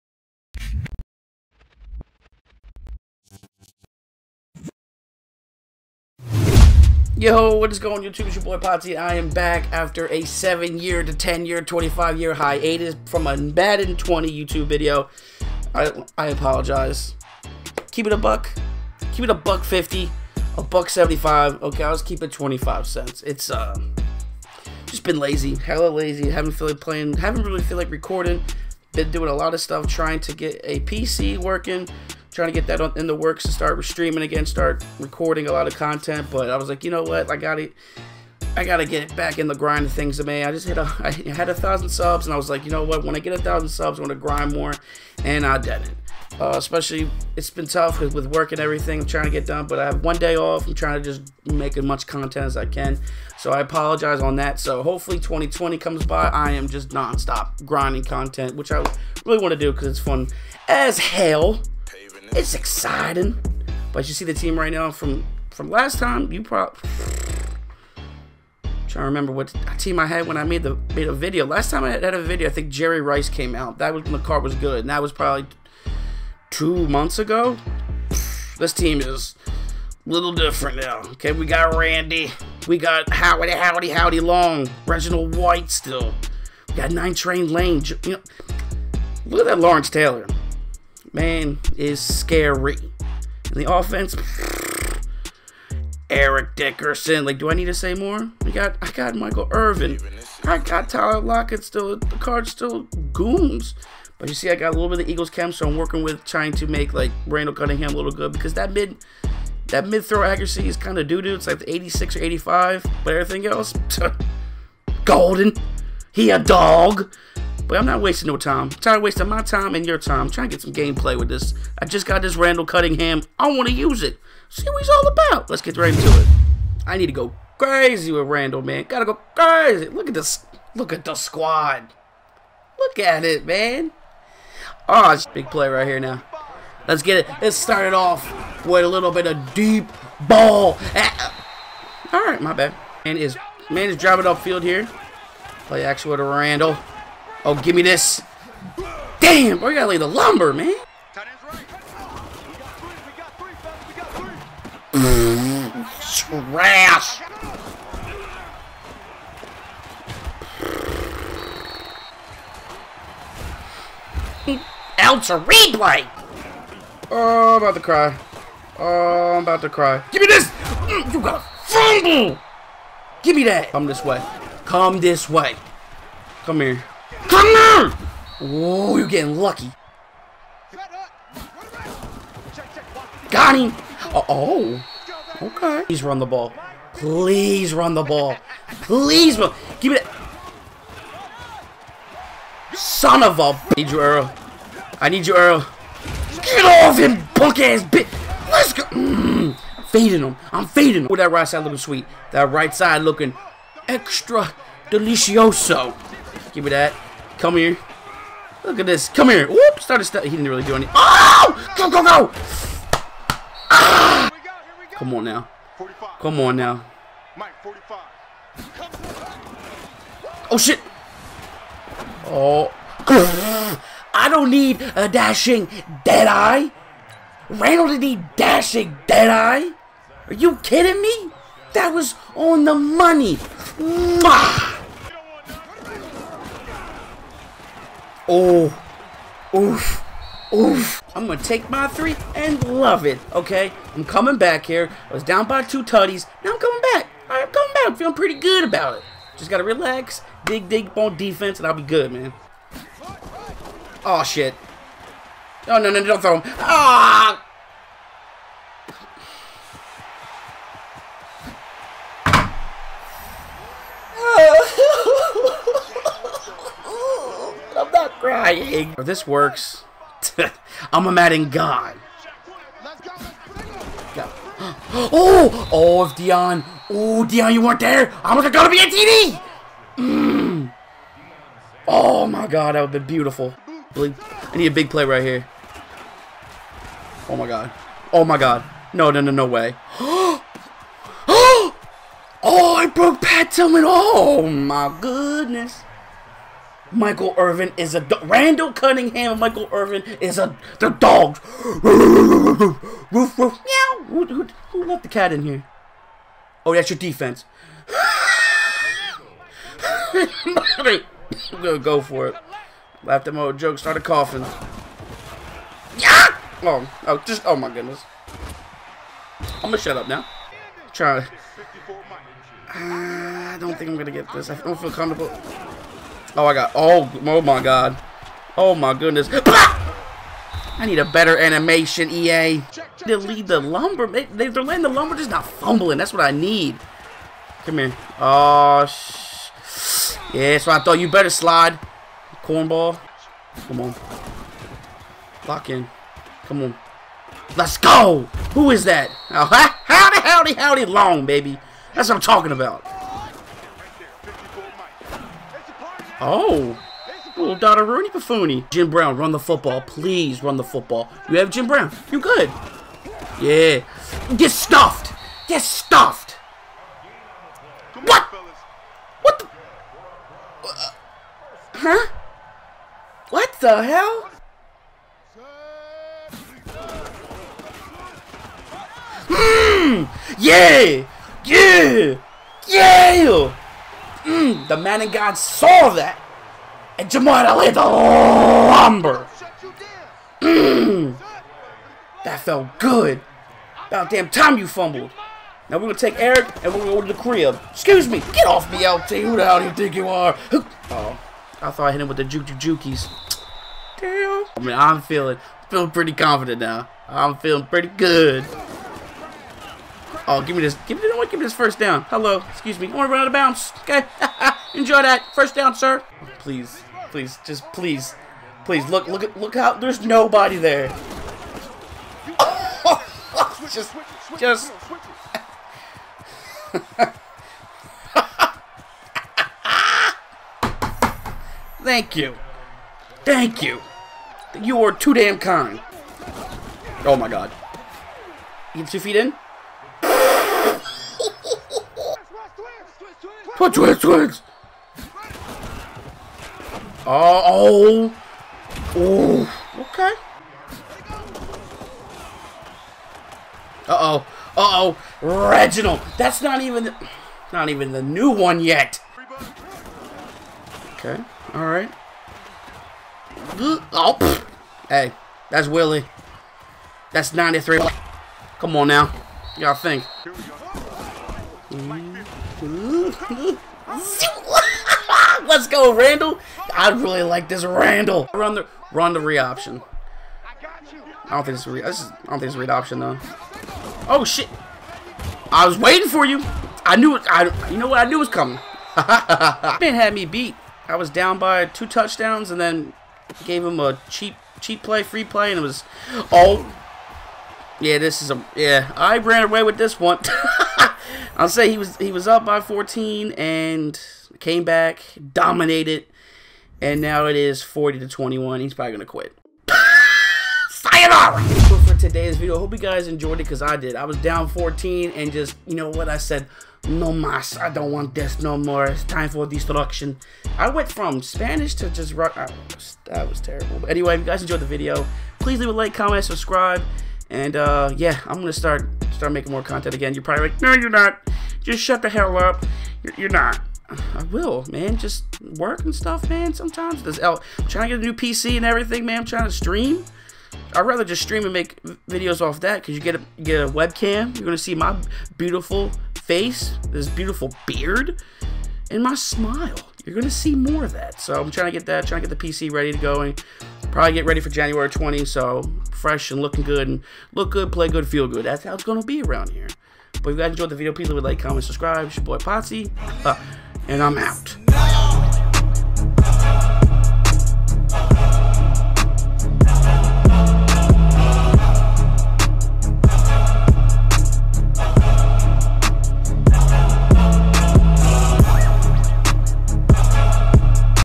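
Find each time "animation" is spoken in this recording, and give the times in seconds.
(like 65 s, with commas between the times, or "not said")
331 s.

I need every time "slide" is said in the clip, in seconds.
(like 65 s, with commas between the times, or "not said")
341 s.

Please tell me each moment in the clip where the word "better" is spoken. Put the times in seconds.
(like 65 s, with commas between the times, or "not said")
331 s, 341 s.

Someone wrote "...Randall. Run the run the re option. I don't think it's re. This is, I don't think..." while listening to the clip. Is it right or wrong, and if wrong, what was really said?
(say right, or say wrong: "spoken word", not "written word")
right.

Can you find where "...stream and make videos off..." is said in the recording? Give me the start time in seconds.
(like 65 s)
541 s.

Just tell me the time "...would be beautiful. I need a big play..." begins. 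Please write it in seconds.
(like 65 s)
282 s.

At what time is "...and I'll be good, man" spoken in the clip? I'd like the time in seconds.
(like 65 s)
251 s.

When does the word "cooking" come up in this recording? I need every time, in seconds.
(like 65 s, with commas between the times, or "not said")
not said.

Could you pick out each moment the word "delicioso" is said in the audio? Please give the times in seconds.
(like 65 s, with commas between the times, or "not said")
204 s.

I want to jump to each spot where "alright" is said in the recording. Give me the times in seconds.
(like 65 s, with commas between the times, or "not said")
461 s.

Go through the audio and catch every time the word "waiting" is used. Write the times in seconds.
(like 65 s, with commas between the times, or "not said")
485 s.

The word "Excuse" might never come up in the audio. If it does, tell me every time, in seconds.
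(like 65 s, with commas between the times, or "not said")
397 s, 412 s.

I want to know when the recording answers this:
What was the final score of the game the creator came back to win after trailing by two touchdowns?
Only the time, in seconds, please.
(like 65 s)
507 s.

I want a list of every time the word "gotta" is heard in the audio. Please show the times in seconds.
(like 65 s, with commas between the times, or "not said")
38 s, 128 s, 149 s.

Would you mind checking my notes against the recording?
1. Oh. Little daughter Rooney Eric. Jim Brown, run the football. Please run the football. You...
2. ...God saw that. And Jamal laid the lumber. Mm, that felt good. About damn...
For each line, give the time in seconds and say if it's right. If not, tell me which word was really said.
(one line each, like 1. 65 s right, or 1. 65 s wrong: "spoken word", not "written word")
1. 356 s wrong: "Buffoony", not "Eric"
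2. 385 s right.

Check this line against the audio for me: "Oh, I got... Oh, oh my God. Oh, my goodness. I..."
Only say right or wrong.
right.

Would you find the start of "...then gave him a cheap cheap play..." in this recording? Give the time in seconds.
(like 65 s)
492 s.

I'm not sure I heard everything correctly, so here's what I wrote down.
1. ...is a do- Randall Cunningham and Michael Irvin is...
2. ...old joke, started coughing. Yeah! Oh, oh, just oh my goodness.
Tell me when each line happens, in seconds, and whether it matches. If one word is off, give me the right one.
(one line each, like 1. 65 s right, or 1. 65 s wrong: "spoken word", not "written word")
1. 297 s right
2. 313 s right.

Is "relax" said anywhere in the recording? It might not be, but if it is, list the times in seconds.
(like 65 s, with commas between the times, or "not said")
249 s.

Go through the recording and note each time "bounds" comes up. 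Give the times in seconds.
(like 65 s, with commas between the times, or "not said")
413 s.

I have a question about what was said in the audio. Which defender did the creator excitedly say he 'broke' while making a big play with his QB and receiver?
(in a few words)
Pat Tillman.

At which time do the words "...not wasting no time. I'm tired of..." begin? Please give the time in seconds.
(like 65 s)
117 s.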